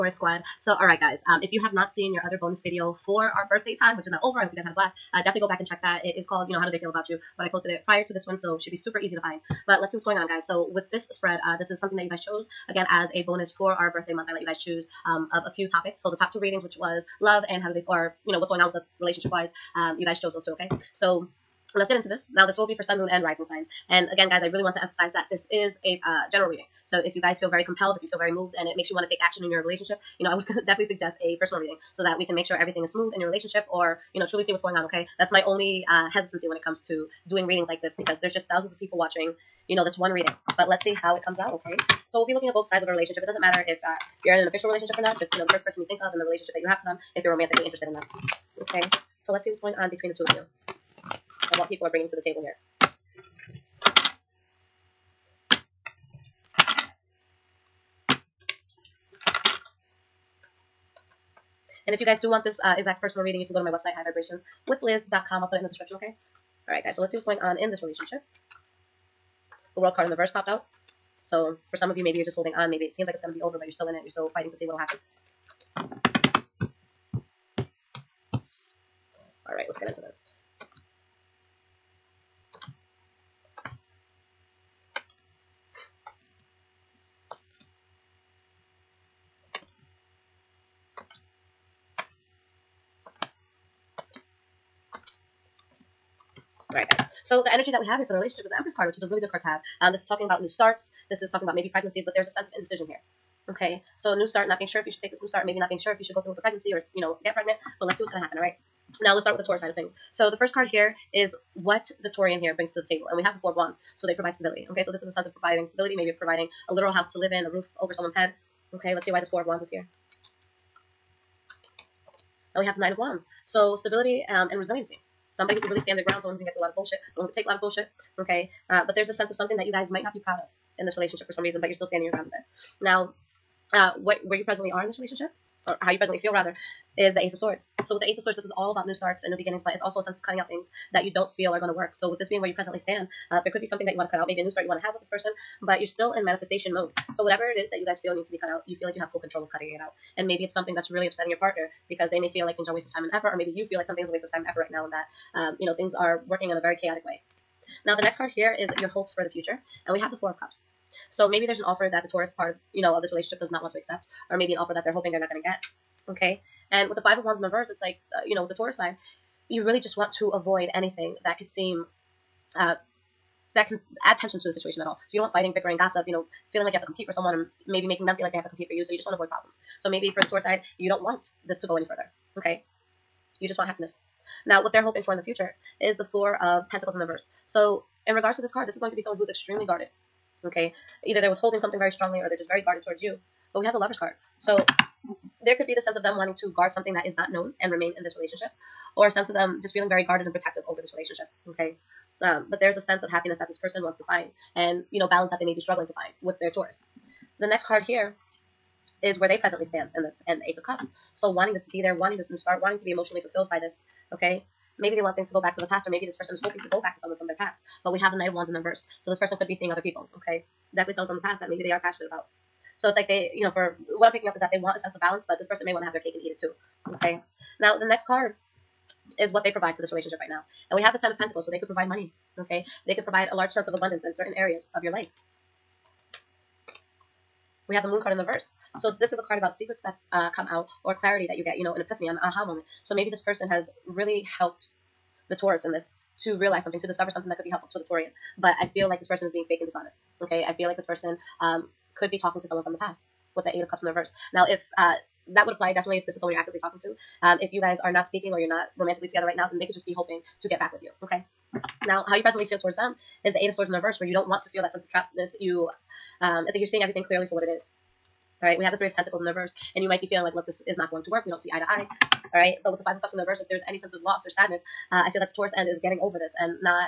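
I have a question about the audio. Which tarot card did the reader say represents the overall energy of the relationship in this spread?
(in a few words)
The Empress.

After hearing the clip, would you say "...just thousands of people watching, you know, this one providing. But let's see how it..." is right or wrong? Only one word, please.
wrong.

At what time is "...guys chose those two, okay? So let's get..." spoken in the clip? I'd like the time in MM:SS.
00:20.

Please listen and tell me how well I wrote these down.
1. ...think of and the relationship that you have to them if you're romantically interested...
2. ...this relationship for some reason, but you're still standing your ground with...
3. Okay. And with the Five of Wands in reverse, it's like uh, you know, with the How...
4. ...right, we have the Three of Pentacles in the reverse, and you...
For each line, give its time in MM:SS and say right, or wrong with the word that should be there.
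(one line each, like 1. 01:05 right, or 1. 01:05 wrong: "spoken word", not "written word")
1. 00:45 right
2. 02:10 right
3. 02:46 wrong: "Taurus", not "How"
4. 04:28 right.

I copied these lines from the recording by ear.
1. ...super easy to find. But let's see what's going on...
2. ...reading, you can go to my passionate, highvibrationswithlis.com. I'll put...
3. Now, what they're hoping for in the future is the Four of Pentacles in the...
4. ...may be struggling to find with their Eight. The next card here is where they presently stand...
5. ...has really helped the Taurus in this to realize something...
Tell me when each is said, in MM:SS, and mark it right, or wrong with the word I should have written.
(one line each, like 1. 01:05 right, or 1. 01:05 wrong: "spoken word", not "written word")
1. 00:08 right
2. 01:03 wrong: "website", not "passionate"
3. 03:04 right
4. 03:25 wrong: "Taurus", not "Eight"
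5. 04:03 right.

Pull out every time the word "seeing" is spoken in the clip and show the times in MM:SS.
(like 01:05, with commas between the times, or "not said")
03:39, 04:26.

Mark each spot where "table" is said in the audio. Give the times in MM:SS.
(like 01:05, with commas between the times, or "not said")
00:52, 01:52.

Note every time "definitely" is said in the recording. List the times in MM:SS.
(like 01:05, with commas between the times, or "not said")
00:05, 00:30, 03:40, 04:15.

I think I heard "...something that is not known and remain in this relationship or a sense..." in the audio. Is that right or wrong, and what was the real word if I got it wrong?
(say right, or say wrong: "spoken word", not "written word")
right.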